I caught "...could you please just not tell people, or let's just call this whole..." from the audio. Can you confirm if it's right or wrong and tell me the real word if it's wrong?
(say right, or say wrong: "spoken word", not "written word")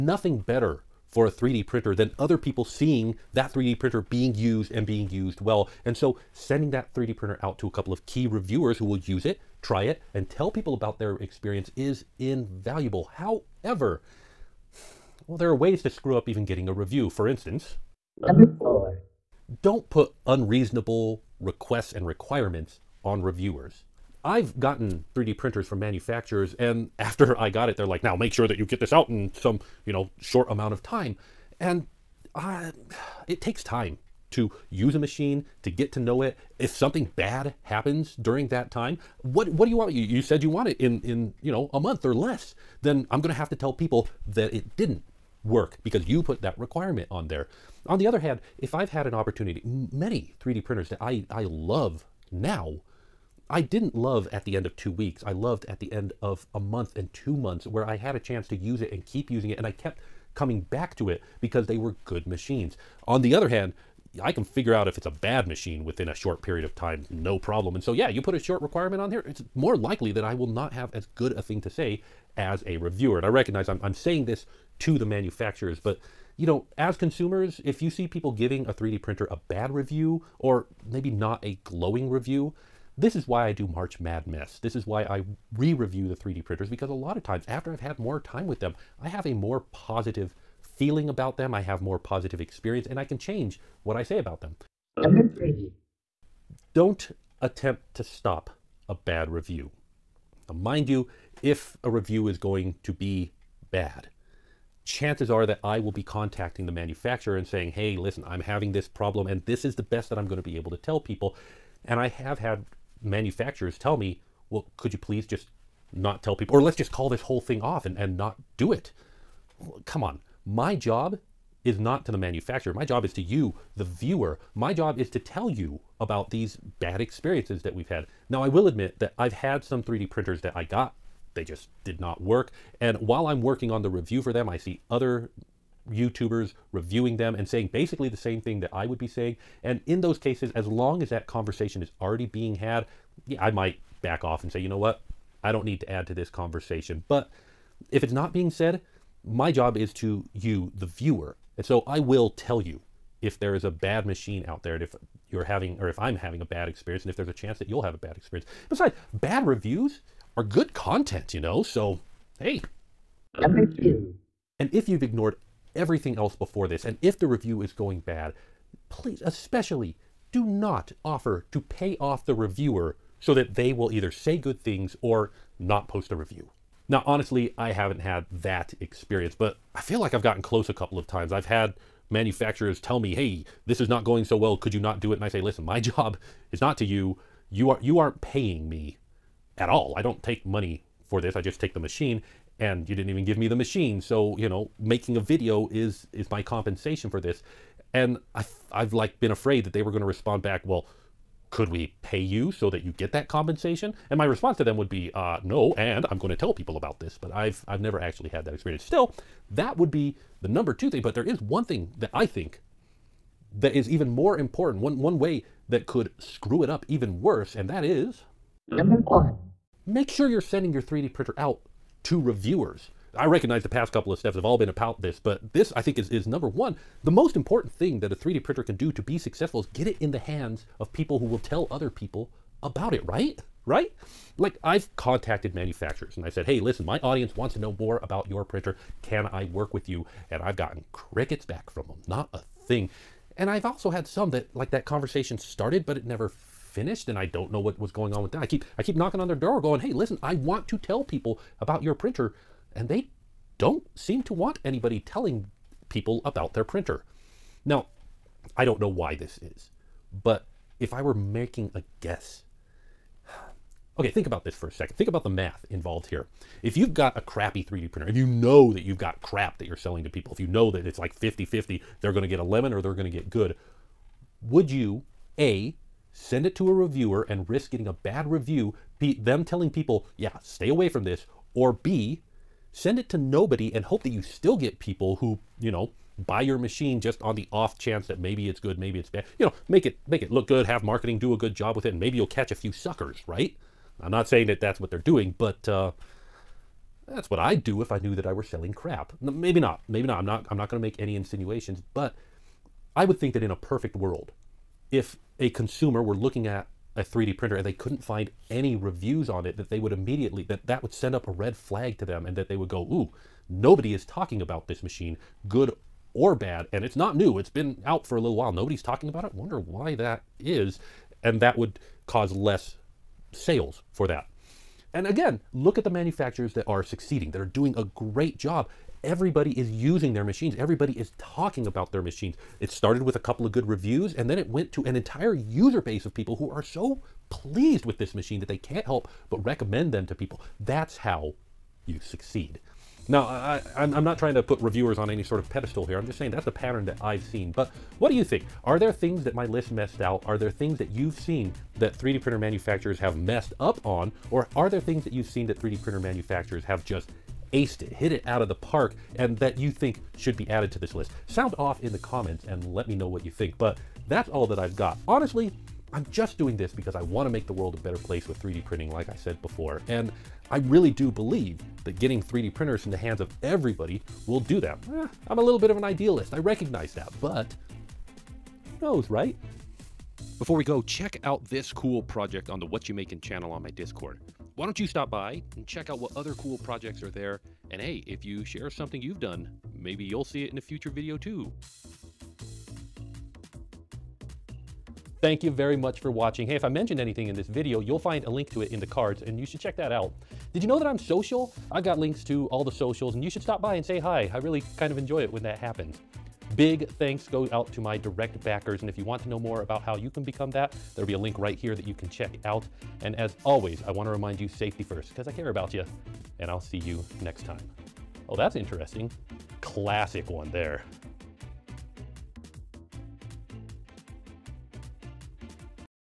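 right.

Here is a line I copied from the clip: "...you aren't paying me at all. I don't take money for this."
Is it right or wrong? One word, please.
right.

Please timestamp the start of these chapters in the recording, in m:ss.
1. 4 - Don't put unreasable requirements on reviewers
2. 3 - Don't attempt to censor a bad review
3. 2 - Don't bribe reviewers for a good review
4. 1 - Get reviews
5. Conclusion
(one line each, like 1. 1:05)
1. 0:17
2. 1:34
3. 2:42
4. 3:38
5. 5:47.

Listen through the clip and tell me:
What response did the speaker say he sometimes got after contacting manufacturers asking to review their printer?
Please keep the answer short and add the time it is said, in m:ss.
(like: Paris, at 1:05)
crickets, at 4:00.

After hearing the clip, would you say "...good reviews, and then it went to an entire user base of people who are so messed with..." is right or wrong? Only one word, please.
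wrong.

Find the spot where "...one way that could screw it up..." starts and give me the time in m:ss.
3:34.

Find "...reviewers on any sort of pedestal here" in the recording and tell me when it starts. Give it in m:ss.
5:44.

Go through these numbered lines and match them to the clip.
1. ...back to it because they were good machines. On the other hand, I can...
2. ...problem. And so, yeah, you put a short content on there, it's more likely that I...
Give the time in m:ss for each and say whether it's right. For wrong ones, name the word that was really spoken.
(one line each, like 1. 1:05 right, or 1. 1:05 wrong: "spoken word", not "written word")
1. 1:00 right
2. 1:07 wrong: "requirement", not "content".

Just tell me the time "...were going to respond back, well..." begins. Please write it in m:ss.
3:19.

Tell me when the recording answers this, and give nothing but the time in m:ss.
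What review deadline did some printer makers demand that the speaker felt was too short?
0:41.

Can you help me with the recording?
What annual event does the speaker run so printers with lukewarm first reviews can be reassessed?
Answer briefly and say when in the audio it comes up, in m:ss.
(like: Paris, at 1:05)
March Madness, at 1:23.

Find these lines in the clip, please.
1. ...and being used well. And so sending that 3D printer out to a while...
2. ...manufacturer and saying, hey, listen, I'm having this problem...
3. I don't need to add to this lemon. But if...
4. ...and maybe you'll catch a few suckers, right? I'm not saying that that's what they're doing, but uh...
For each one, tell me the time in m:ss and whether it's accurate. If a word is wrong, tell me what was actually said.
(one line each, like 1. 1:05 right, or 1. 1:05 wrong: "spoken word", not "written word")
1. 0:04 wrong: "couple", not "while"
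2. 1:46 right
3. 2:25 wrong: "conversation", not "lemon"
4. 4:51 right.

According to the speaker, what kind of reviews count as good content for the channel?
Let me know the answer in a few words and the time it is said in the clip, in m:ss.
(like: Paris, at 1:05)
bad reviews, at 2:39.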